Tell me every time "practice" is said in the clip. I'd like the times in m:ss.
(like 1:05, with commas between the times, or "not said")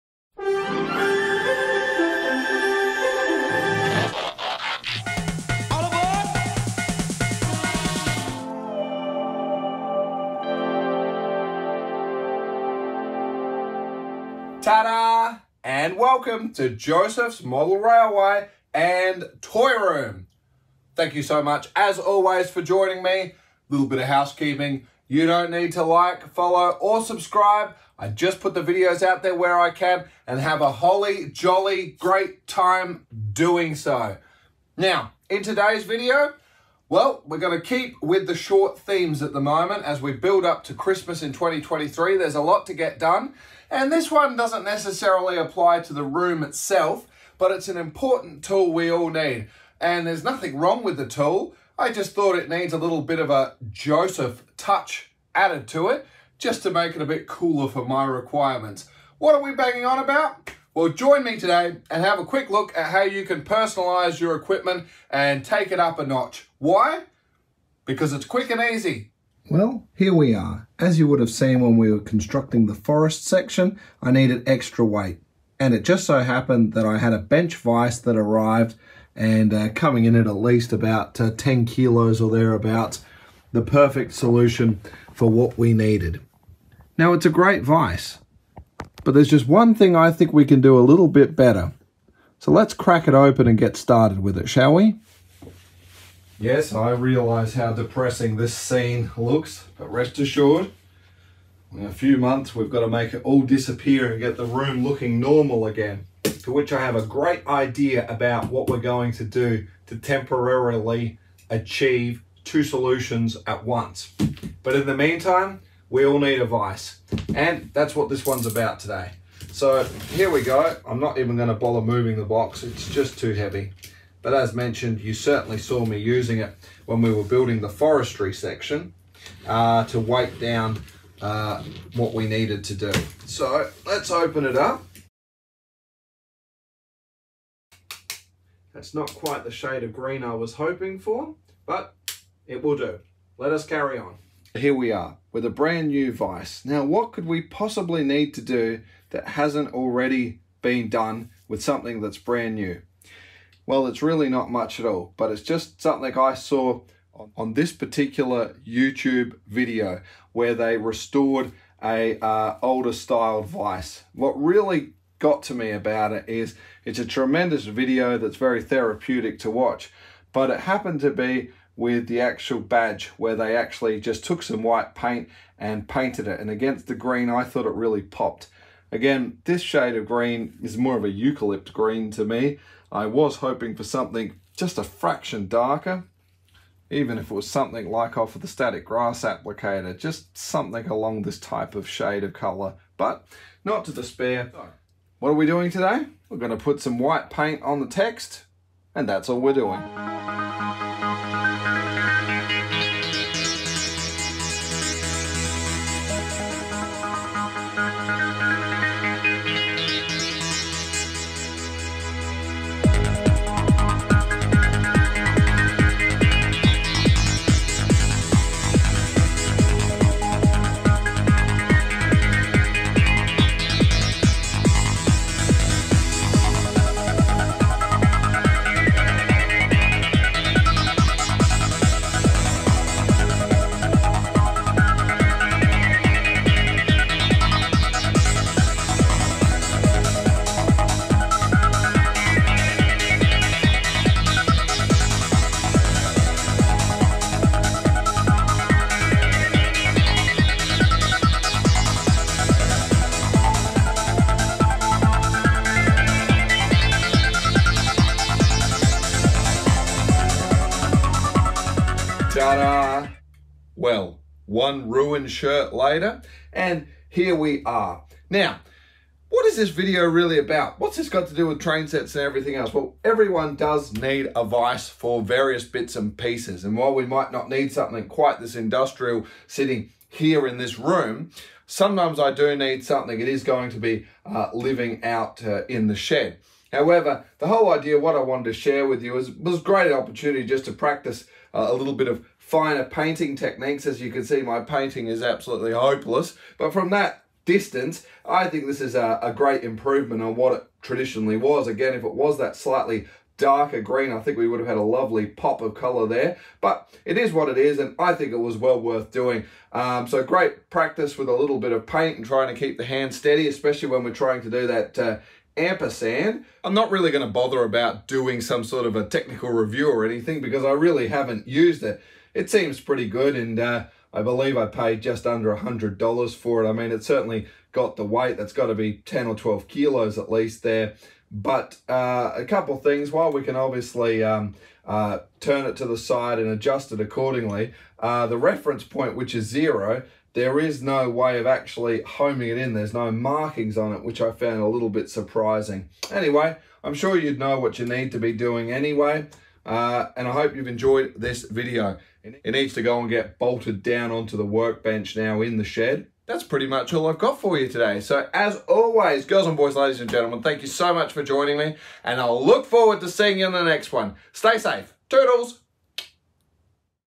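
4:50, 5:10.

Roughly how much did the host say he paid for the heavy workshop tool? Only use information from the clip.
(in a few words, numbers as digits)
just under $100.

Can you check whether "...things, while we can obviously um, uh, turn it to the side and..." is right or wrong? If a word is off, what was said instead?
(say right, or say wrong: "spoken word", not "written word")
right.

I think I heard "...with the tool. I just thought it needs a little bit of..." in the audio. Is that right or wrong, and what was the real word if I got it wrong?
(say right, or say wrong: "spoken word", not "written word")
right.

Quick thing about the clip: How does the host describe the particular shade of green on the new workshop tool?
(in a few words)
eucalypt green.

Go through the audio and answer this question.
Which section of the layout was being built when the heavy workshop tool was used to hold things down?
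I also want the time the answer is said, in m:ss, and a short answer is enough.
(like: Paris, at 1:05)
forest section, at 1:12.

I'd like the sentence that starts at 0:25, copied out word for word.
You don't need to like, follow, or subscribe.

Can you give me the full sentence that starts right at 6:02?
And I'll look forward to seeing you in the next one.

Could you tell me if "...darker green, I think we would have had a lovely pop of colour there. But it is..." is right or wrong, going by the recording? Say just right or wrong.
right.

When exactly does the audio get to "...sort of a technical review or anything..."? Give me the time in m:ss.
5:18.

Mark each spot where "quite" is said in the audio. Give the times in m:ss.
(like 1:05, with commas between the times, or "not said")
2:19, 4:38.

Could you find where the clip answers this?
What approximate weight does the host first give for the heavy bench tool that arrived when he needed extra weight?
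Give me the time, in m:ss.
1:21.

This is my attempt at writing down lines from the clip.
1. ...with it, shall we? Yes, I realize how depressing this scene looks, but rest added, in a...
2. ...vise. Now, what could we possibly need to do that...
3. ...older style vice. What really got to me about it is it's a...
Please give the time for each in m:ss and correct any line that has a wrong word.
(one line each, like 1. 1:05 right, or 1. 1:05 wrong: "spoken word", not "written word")
1. 1:34 wrong: "assured", not "added"
2. 2:26 right
3. 2:42 right.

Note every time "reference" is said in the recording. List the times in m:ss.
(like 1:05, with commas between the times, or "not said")
5:38.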